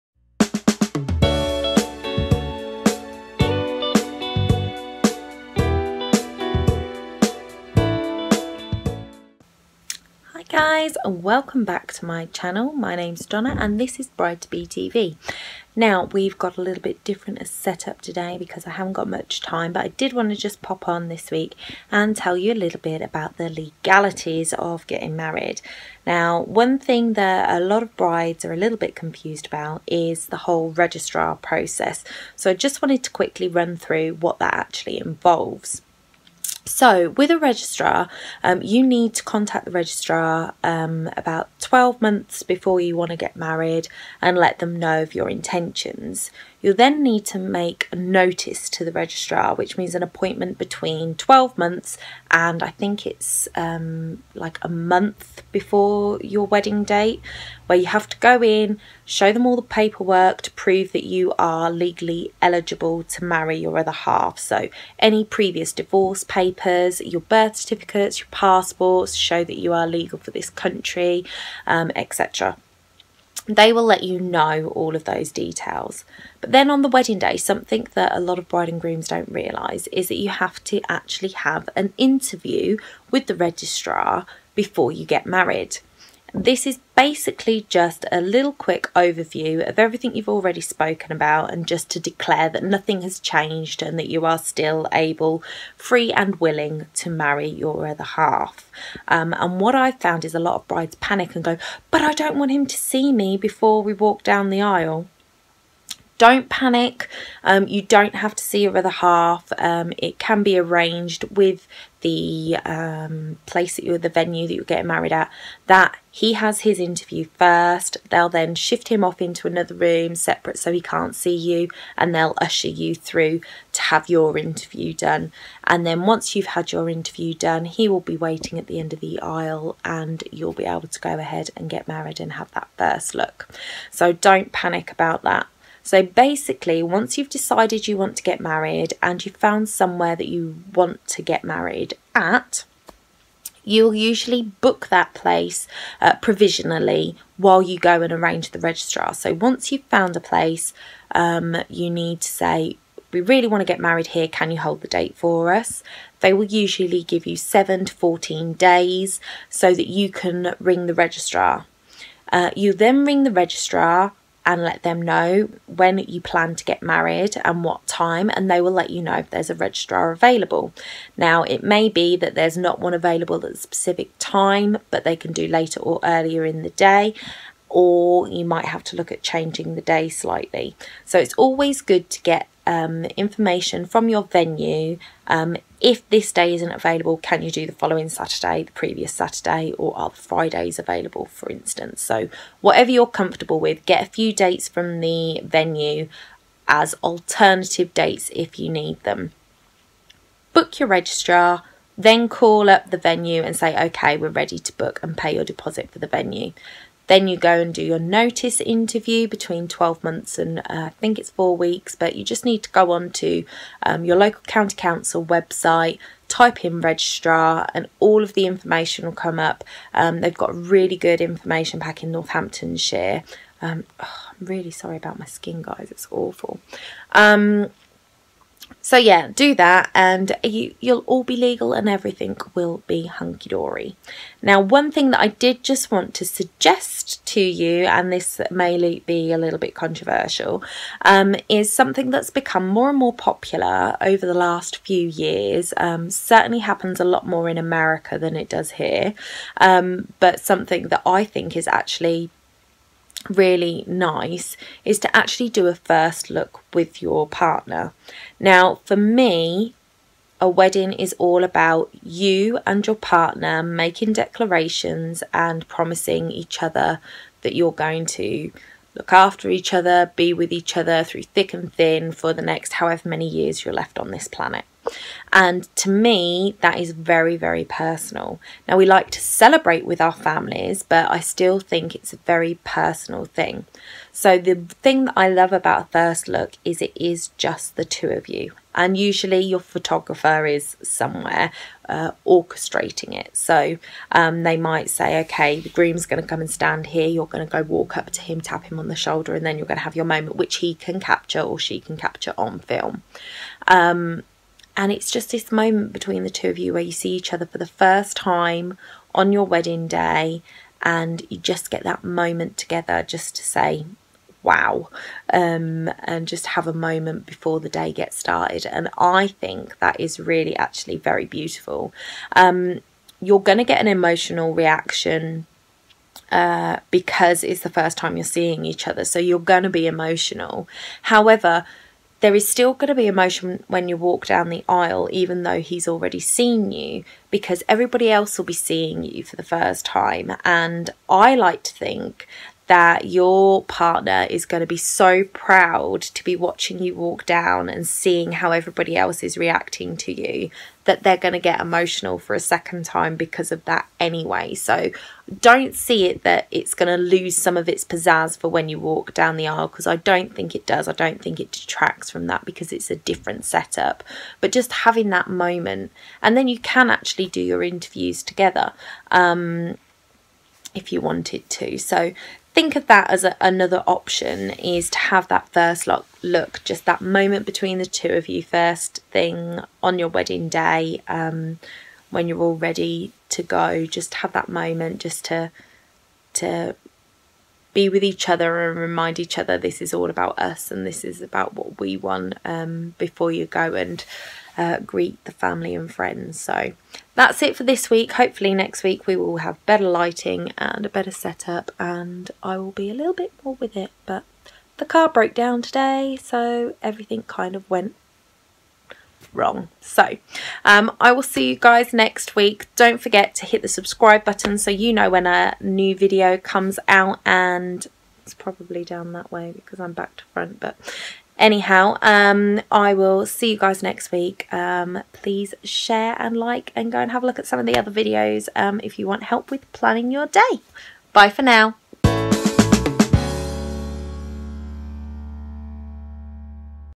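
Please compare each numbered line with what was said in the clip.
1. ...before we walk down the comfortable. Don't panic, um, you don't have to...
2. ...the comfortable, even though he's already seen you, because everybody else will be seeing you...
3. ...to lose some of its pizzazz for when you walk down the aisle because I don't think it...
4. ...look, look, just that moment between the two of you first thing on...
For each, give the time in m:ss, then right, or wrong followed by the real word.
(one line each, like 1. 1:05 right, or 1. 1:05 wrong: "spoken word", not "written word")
1. 1:43 wrong: "aisle", not "comfortable"
2. 5:34 wrong: "aisle", not "comfortable"
3. 5:56 right
4. 6:15 right.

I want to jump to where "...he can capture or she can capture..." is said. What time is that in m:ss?
5:00.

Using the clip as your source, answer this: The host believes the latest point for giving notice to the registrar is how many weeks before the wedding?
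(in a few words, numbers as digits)
4 weeks.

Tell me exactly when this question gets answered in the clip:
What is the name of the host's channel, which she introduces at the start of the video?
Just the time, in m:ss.
0:14.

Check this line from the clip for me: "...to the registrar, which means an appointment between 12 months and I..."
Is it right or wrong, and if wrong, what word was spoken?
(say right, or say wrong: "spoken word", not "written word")
right.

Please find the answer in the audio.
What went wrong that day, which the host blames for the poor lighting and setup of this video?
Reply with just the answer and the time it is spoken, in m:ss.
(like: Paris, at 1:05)
The car broke down, at 6:44.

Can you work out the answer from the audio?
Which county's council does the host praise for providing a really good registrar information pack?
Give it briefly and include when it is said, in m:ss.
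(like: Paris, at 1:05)
Northamptonshire, at 3:42.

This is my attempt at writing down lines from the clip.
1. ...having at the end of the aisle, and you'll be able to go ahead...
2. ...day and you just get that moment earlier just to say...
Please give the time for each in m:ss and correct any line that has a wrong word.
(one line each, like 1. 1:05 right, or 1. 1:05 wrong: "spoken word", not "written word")
1. 2:08 wrong: "waiting", not "having"
2. 5:09 wrong: "together", not "earlier".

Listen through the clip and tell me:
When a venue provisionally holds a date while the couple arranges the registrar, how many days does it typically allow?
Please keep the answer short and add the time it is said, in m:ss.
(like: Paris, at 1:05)
7 to 14 days, at 2:37.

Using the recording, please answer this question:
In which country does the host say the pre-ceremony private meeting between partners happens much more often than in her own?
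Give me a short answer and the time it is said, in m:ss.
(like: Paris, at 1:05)
America, at 4:07.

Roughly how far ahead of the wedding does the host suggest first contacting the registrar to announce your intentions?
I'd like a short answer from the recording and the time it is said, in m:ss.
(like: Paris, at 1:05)
12 months, at 0:41.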